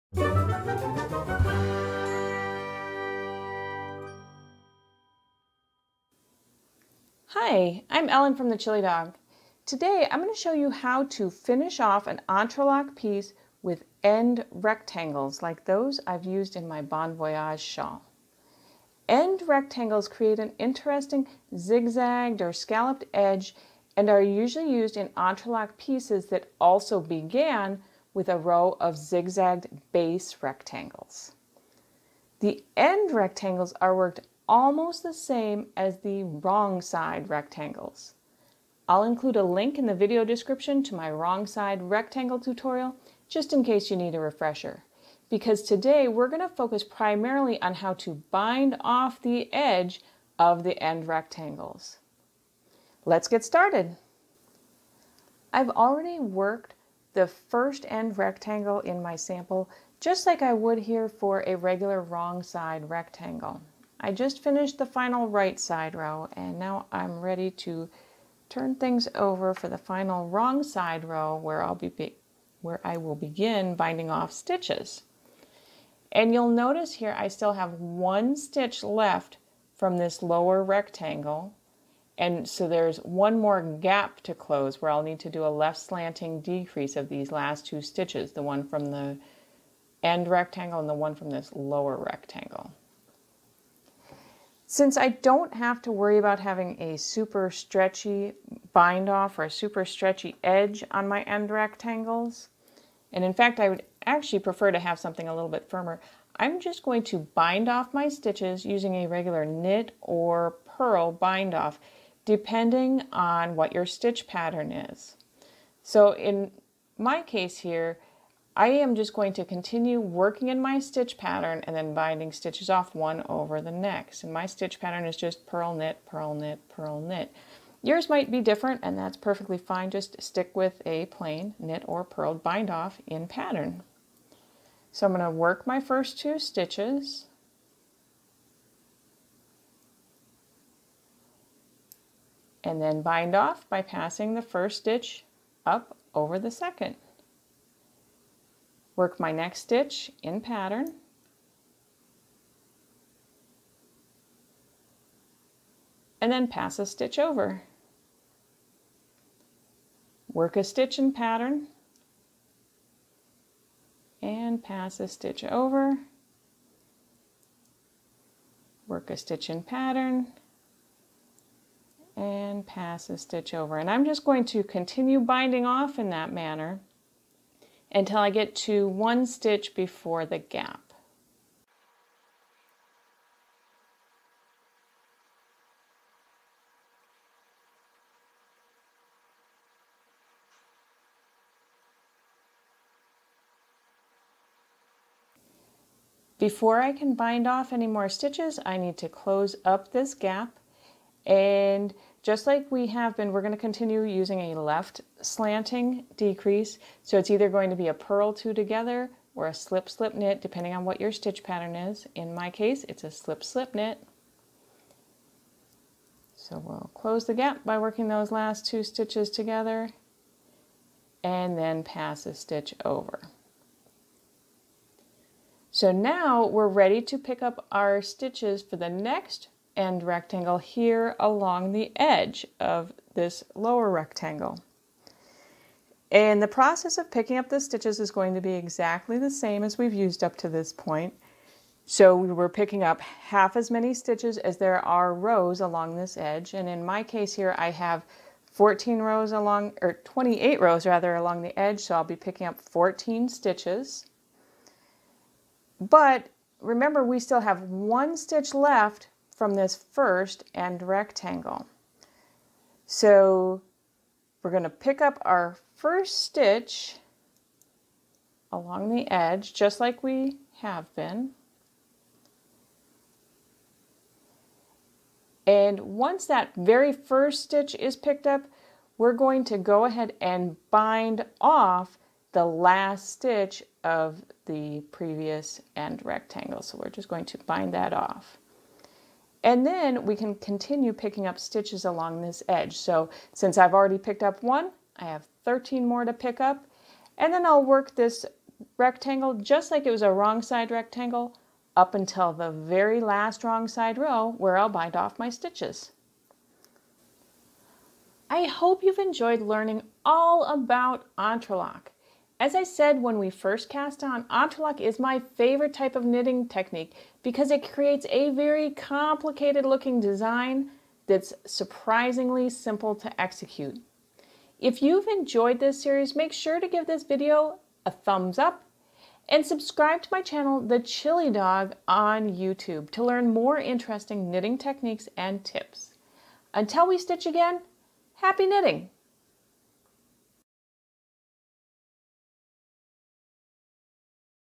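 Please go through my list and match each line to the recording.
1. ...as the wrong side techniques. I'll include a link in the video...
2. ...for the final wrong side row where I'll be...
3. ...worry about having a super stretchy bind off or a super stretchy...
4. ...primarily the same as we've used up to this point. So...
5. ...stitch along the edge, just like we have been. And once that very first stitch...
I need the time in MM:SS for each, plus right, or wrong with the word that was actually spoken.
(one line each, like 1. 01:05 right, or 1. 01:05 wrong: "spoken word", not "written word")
1. 00:35 wrong: "rectangles", not "techniques"
2. 01:09 right
3. 01:35 right
4. 03:58 wrong: "exactly", not "primarily"
5. 04:26 right.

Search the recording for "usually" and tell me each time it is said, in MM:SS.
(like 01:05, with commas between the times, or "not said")
00:24.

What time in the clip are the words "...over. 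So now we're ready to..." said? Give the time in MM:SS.
03:42.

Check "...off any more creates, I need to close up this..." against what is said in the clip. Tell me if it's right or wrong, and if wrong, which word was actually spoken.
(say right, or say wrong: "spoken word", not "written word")
wrong: "stitches", not "creates".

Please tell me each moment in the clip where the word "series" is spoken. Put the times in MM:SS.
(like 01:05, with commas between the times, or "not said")
05:25.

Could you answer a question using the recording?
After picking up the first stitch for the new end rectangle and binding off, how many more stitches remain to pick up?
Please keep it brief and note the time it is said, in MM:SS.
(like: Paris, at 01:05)
13, at 04:55.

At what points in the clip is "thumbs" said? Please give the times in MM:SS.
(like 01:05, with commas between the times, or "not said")
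05:27.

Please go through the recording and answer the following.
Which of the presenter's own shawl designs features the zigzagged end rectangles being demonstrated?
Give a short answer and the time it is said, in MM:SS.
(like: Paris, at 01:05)
Bon Voyage, at 00:16.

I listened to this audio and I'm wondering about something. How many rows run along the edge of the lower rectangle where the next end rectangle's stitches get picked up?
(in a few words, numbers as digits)
28.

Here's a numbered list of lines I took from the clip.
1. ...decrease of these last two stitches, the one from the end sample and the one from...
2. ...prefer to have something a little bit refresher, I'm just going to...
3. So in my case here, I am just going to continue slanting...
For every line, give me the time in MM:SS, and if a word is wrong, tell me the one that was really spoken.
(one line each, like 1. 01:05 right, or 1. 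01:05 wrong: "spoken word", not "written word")
1. 01:26 wrong: "rectangle", not "sample"
2. 01:44 wrong: "firmer", not "refresher"
3. 01:55 wrong: "working", not "slanting".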